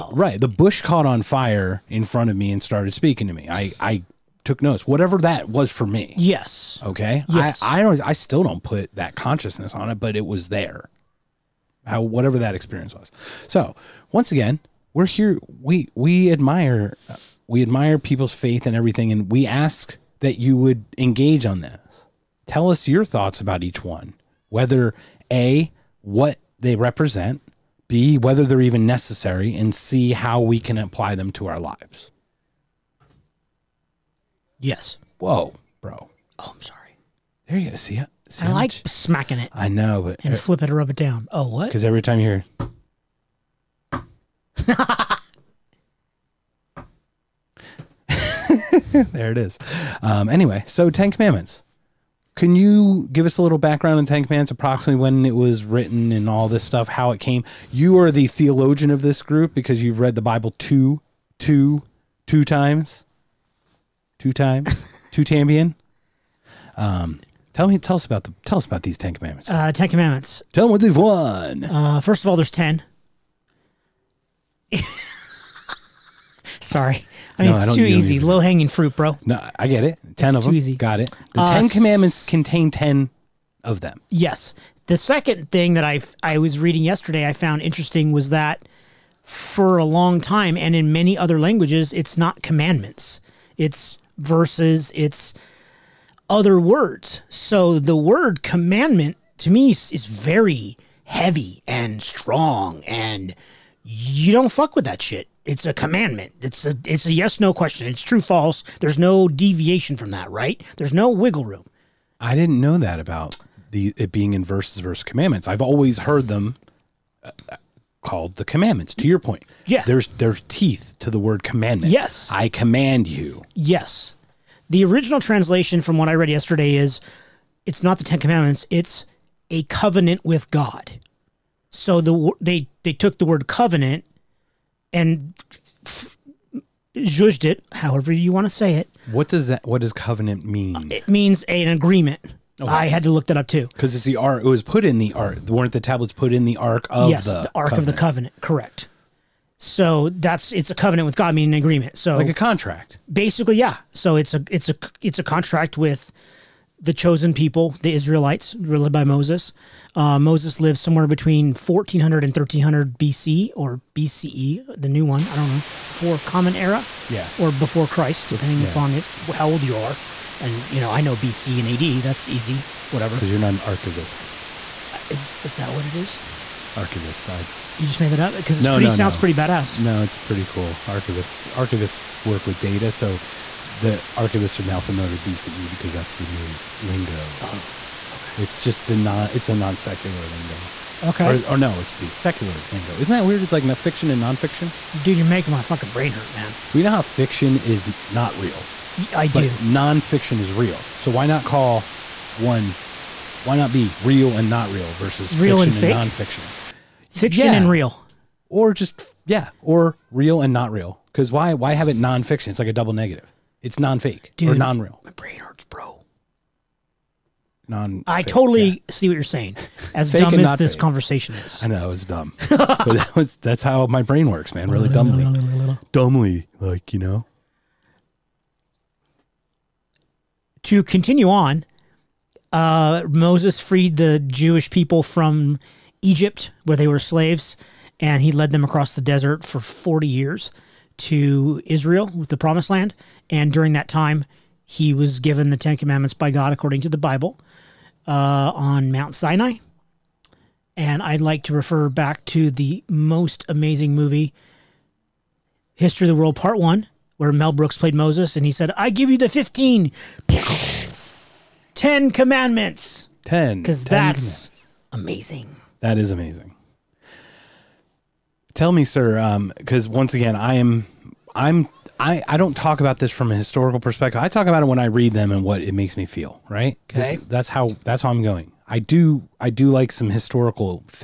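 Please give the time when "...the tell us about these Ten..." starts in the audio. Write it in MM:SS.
01:08.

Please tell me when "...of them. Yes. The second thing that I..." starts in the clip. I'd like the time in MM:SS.
01:23.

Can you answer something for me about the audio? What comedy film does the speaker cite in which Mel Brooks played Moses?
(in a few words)
History of the World Part One.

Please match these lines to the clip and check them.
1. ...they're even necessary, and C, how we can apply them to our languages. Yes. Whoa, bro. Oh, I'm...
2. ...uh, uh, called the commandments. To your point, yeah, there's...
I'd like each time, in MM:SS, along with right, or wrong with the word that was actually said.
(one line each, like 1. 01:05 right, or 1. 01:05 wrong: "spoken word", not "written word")
1. 00:28 wrong: "lives", not "languages"
2. 01:57 right.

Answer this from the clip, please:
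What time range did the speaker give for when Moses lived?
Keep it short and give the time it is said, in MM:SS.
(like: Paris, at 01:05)
1400 to 1300 BC, at 02:41.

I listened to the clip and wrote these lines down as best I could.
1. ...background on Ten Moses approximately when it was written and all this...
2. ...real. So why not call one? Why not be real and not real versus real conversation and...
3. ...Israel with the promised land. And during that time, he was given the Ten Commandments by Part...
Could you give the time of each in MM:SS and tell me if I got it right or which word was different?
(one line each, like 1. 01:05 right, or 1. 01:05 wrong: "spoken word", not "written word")
1. 00:53 wrong: "Commandments", not "Moses"
2. 03:20 wrong: "fiction", not "conversation"
3. 04:01 wrong: "God", not "Part".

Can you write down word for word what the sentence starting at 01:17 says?
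I mean, No, it's too easy.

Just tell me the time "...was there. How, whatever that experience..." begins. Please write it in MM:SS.
00:10.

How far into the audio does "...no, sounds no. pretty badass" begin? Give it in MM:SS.
02:58.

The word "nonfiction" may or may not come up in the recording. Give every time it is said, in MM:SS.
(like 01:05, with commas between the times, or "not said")
03:14, 03:19, 03:26, 03:31.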